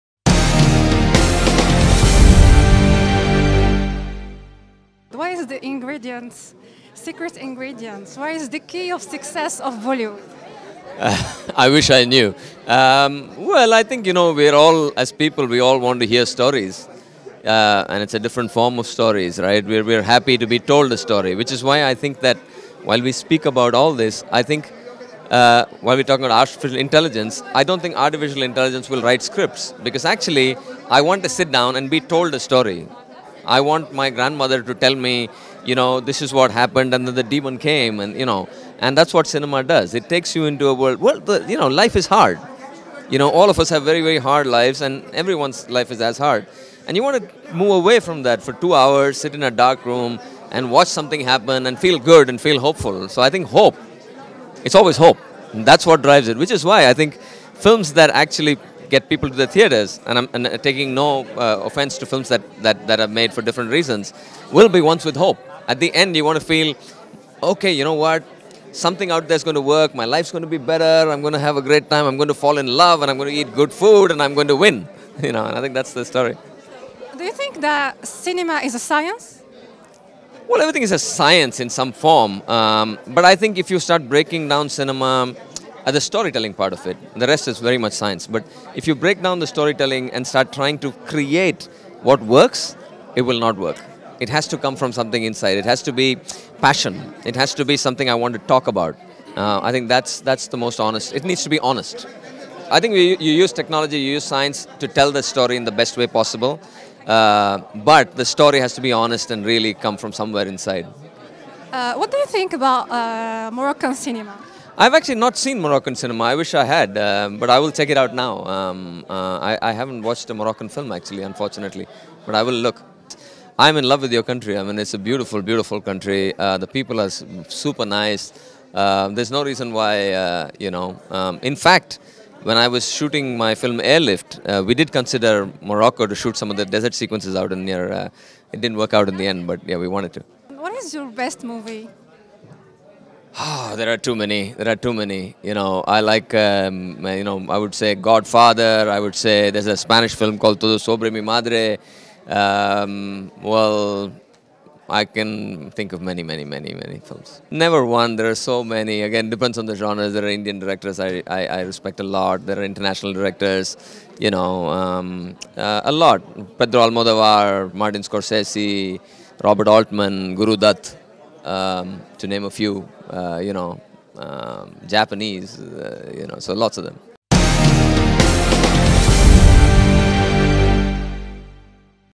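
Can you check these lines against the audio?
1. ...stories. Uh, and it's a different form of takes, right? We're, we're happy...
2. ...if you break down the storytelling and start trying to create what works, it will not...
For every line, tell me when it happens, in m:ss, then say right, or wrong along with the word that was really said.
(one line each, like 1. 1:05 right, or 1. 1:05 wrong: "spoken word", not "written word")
1. 0:16 wrong: "stories", not "takes"
2. 1:28 right.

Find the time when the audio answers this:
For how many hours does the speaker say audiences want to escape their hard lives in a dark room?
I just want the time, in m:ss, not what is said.
0:48.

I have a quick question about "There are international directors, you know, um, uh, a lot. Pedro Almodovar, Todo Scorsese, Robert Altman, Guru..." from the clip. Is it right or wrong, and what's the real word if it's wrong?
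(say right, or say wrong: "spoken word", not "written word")
wrong: "Martin", not "Todo".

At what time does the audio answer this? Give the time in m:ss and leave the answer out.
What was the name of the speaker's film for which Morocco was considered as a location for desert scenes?
2:13.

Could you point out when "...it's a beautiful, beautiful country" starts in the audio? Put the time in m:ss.
2:04.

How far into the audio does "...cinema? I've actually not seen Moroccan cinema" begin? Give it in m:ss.
1:53.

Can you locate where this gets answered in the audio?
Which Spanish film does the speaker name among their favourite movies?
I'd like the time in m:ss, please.
2:30.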